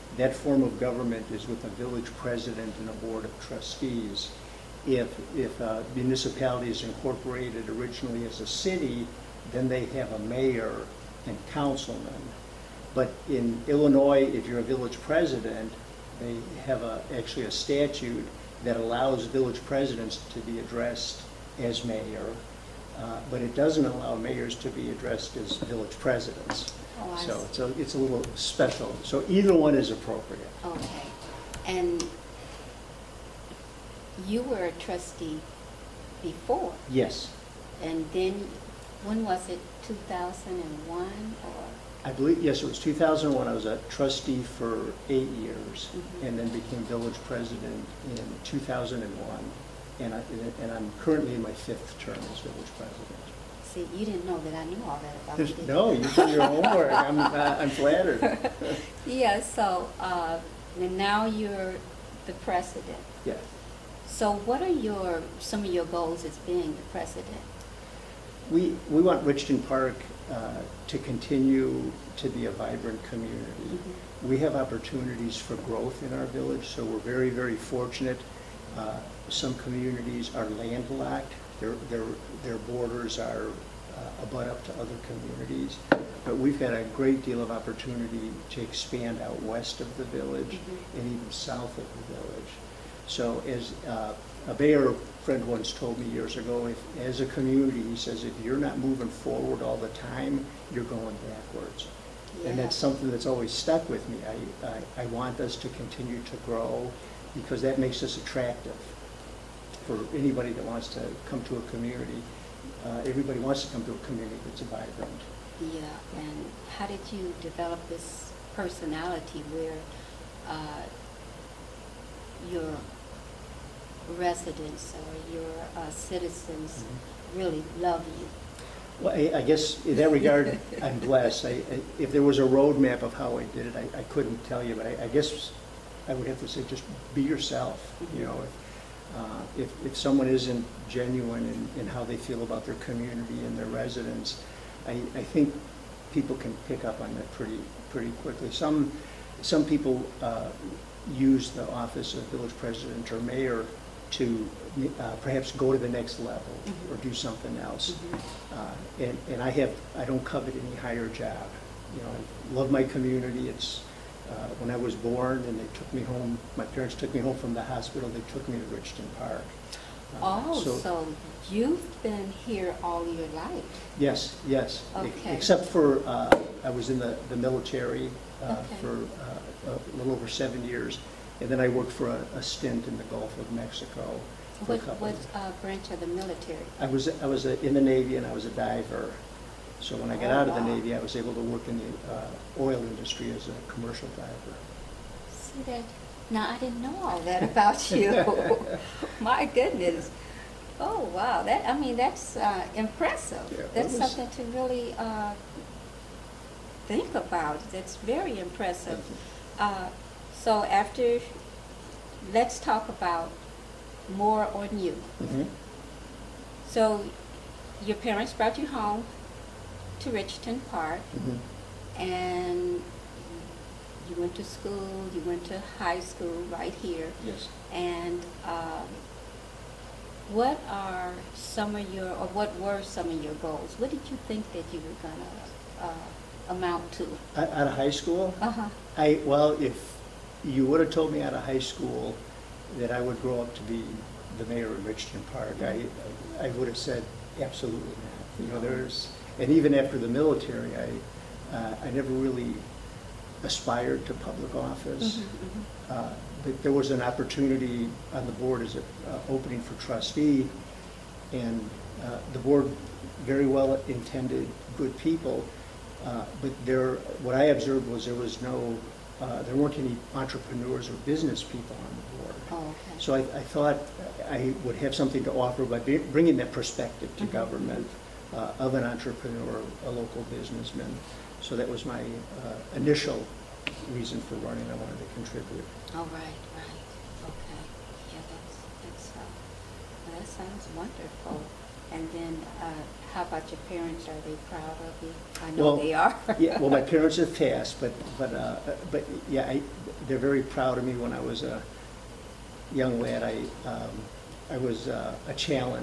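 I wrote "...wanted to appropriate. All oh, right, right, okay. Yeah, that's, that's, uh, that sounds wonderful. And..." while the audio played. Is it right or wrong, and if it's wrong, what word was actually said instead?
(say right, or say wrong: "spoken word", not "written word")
wrong: "contribute", not "appropriate".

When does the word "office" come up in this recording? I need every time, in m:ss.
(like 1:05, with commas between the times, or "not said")
2:31, 4:14.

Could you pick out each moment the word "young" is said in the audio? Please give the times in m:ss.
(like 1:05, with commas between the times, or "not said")
5:02.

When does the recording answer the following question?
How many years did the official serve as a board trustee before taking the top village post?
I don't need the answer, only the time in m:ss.
0:45.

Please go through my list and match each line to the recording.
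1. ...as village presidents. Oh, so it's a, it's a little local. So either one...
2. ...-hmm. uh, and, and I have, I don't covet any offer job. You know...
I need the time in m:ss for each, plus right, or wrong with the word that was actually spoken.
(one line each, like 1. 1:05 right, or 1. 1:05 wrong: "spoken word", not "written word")
1. 0:25 wrong: "special", not "local"
2. 2:37 wrong: "higher", not "offer".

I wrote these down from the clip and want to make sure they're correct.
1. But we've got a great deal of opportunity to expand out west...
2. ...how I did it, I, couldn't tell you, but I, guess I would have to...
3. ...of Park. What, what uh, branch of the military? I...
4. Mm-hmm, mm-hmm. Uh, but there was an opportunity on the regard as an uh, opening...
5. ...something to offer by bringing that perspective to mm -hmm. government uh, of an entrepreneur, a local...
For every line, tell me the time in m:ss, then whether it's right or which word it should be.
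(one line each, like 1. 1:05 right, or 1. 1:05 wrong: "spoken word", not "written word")
1. 1:26 right
2. 2:13 right
3. 3:03 wrong: "Mexico", not "Park"
4. 4:15 wrong: "board", not "regard"
5. 4:34 right.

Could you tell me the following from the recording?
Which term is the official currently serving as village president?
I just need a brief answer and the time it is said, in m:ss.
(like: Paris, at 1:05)
Fifth, at 0:51.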